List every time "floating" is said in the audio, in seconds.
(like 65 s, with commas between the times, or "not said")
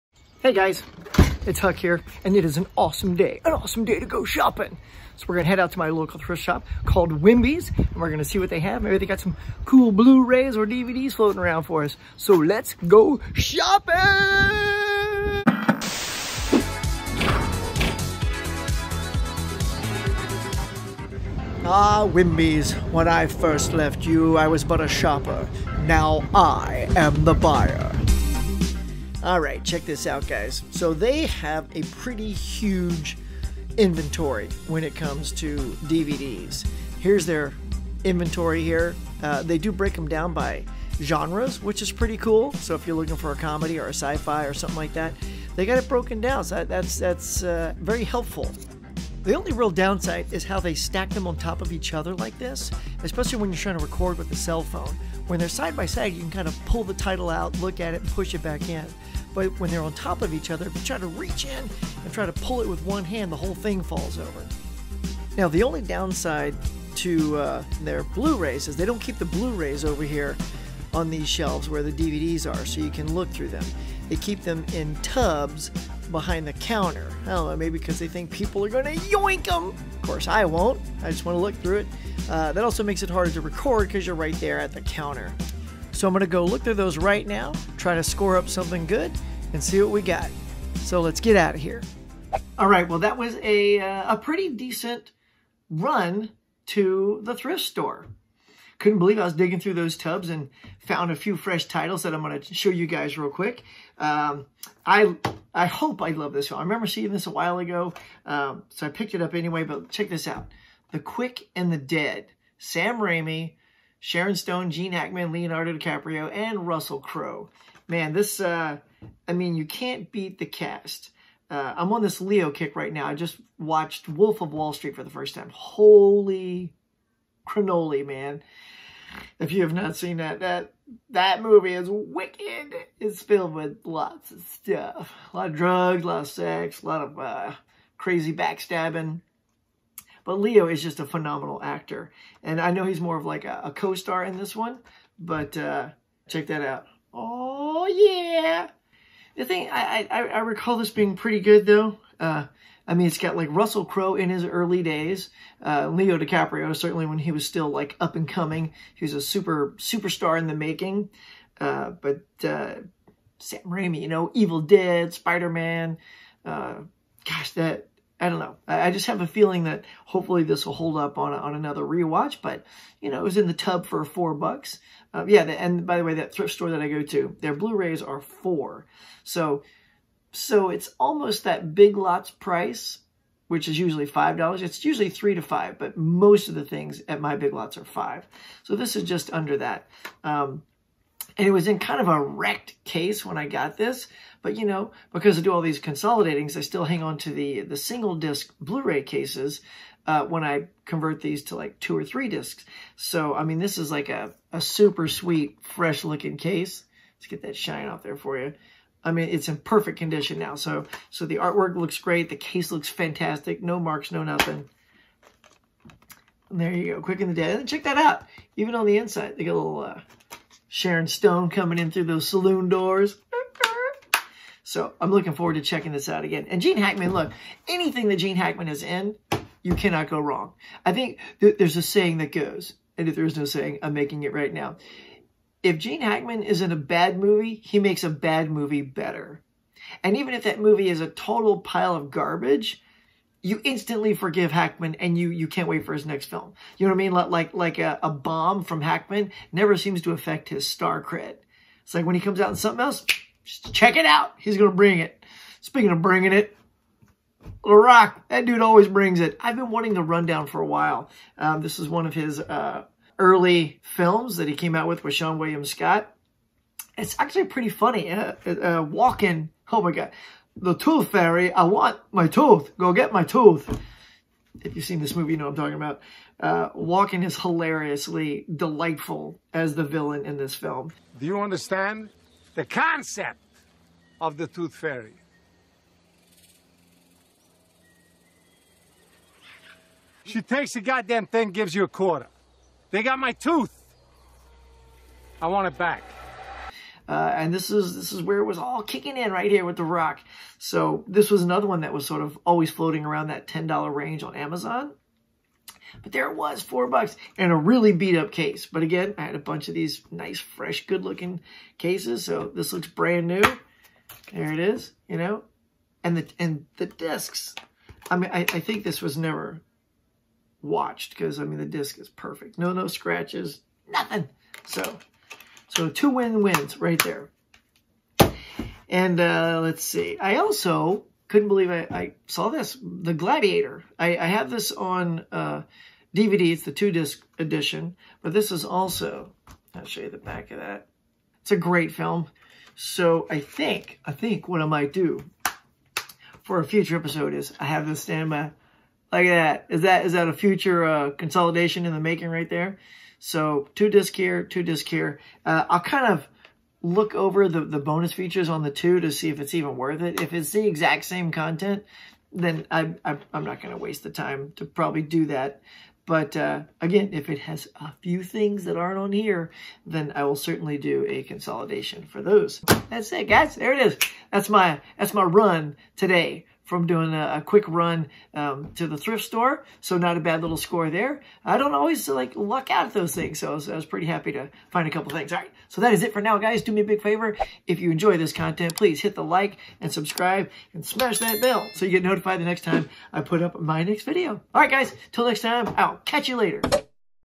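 11 s, 302 s.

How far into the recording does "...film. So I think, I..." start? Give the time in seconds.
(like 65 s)
341 s.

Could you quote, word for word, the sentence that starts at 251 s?
It's like when he comes out in something else, check it out.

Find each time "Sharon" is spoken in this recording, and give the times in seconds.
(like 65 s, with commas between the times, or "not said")
113 s, 220 s.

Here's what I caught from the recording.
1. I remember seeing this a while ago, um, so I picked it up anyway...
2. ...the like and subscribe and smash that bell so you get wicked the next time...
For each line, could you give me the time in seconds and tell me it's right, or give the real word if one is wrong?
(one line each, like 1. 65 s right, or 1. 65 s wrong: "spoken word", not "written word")
1. 106 s right
2. 389 s wrong: "notified", not "wicked".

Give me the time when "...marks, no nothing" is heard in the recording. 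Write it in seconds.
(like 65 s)
213 s.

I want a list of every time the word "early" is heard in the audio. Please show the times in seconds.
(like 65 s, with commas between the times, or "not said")
154 s, 263 s.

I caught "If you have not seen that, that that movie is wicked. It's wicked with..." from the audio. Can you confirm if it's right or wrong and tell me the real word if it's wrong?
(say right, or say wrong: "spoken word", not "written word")
wrong: "filled", not "wicked".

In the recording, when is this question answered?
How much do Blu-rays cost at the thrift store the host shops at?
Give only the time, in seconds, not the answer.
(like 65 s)
177 s.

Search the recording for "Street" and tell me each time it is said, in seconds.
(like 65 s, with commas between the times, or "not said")
124 s.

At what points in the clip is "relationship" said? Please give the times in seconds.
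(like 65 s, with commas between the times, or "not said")
not said.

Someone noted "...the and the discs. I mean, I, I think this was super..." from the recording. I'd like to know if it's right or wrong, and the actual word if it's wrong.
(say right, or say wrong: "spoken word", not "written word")
wrong: "never", not "super".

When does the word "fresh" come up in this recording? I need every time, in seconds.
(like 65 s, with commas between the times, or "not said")
101 s, 205 s, 310 s.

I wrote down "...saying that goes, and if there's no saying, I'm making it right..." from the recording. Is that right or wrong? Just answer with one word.
right.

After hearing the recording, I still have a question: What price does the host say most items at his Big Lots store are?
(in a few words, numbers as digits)
$5.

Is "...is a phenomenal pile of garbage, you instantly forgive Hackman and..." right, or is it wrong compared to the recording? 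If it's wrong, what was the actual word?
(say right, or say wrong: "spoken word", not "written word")
wrong: "total", not "phenomenal".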